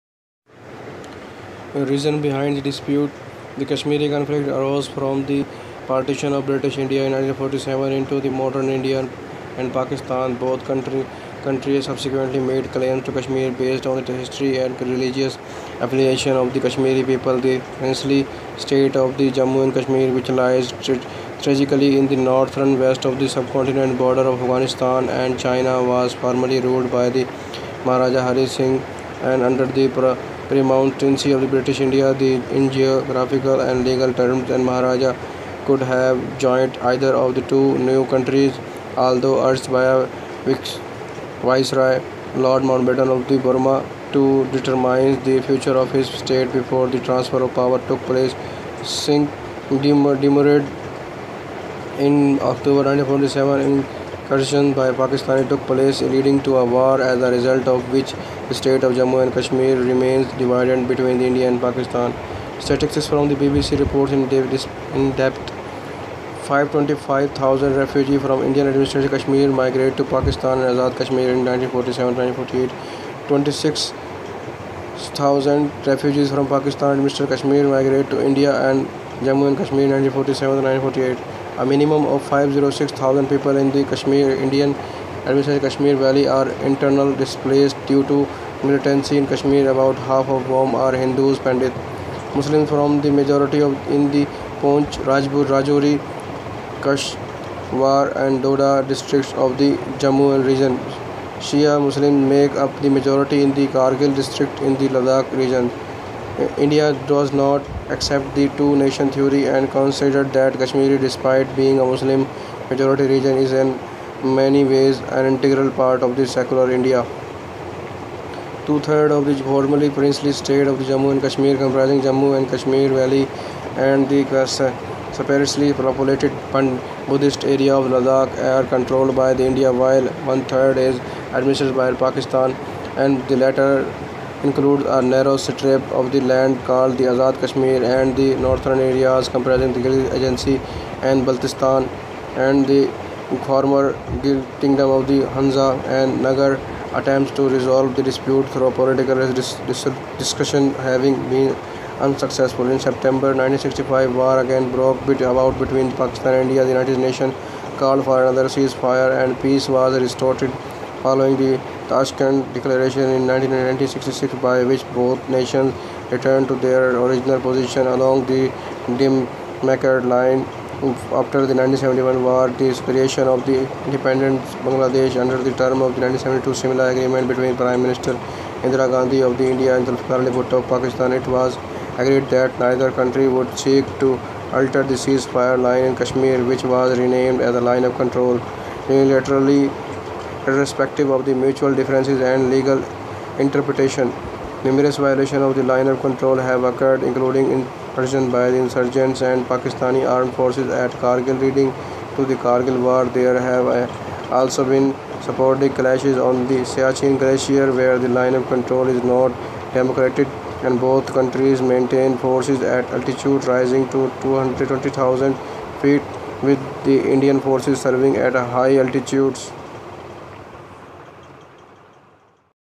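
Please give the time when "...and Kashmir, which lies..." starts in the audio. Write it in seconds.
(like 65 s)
19 s.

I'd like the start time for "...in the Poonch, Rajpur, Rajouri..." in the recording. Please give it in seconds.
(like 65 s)
93 s.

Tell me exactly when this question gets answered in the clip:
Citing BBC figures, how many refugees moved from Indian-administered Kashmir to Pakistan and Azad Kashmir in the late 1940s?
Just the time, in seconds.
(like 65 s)
66 s.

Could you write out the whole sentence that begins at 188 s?
Unilaterally, irrespective of the mutual differences and legal interpretation.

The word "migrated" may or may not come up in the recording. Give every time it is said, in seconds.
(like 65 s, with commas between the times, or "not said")
69 s, 77 s.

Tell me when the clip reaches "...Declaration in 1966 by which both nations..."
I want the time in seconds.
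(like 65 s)
162 s.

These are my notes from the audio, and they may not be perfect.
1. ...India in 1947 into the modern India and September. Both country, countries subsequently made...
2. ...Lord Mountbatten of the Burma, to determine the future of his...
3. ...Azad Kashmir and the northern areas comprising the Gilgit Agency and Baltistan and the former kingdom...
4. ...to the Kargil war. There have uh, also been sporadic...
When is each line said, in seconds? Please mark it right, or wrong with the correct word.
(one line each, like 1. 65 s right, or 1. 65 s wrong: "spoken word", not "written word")
1. 6 s wrong: "Pakistan", not "September"
2. 42 s right
3. 137 s right
4. 202 s right.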